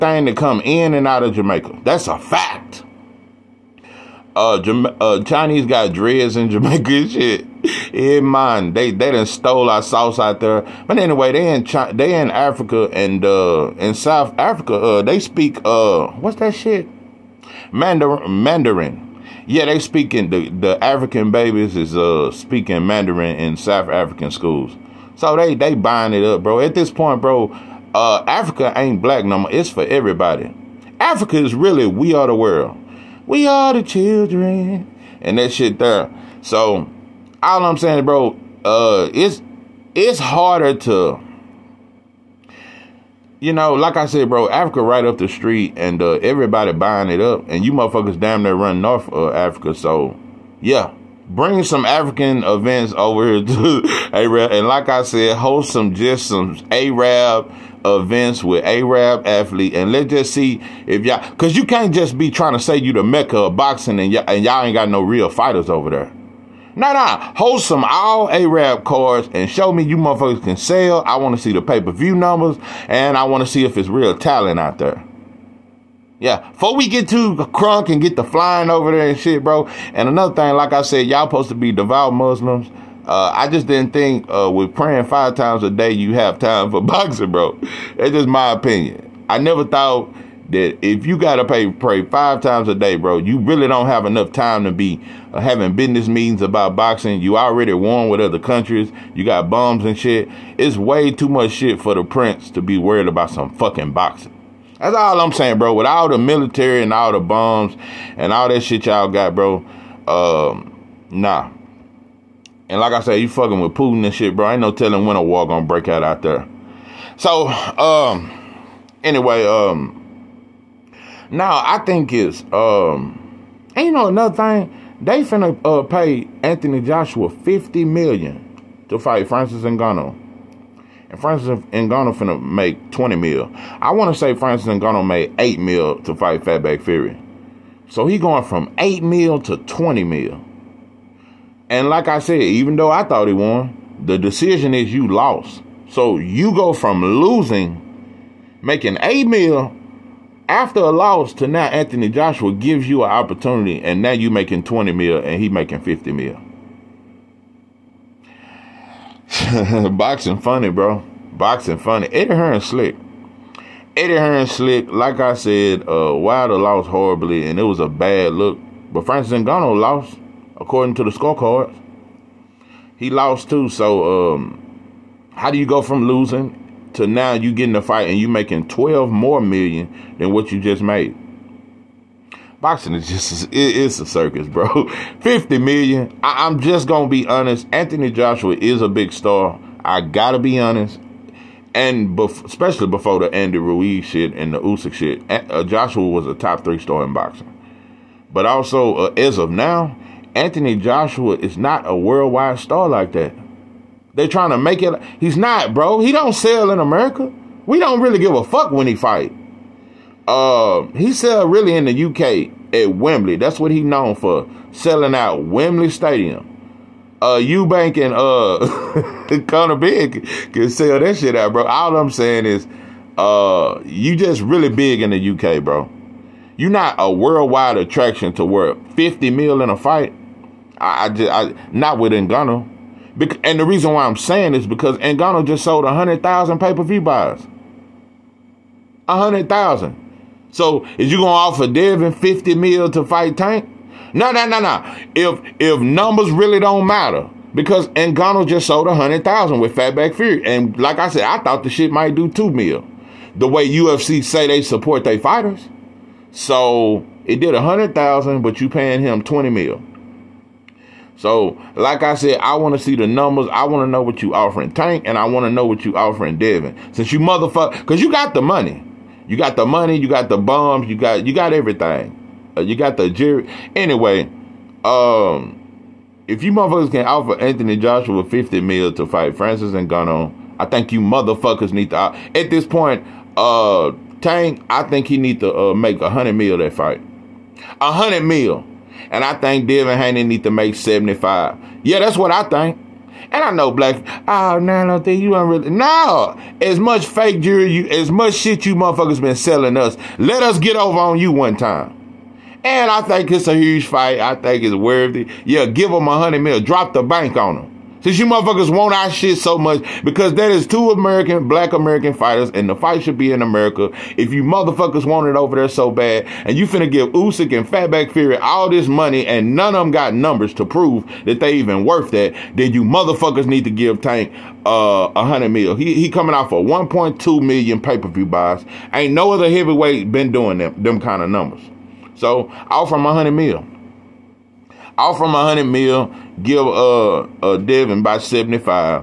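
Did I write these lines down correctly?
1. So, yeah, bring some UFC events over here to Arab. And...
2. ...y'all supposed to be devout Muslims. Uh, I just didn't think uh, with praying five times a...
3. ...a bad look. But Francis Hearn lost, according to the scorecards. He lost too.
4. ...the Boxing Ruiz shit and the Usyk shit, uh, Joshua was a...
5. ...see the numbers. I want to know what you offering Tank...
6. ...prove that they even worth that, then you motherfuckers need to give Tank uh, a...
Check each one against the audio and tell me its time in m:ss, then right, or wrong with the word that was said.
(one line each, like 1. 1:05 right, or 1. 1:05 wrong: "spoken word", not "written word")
1. 0:49 wrong: "African", not "UFC"
2. 1:21 right
3. 2:47 wrong: "Ngannou", not "Hearn"
4. 3:13 wrong: "Andy", not "Boxing"
5. 4:22 right
6. 5:20 right.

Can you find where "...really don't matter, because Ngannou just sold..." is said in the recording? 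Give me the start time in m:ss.
4:06.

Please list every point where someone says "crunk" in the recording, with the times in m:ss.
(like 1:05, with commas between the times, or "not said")
1:17.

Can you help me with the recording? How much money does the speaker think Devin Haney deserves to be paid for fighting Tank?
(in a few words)
75 million.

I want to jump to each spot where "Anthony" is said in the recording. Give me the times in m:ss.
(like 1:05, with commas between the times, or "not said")
2:06, 2:31, 3:07, 3:20, 4:37.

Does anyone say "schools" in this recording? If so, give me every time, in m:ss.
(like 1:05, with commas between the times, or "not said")
0:24.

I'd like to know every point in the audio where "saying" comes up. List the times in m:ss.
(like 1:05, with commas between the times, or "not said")
0:37, 1:45, 3:42, 3:54.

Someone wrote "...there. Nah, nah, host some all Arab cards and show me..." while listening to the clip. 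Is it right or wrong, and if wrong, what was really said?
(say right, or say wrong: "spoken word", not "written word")
right.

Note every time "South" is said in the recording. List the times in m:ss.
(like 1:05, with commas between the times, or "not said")
0:13, 0:23.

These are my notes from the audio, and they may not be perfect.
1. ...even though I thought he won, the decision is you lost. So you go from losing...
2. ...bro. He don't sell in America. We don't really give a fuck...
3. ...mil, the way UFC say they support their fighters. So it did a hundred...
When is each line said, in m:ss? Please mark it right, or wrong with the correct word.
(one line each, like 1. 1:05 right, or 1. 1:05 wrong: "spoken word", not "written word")
1. 2:22 right
2. 3:25 right
3. 4:12 right.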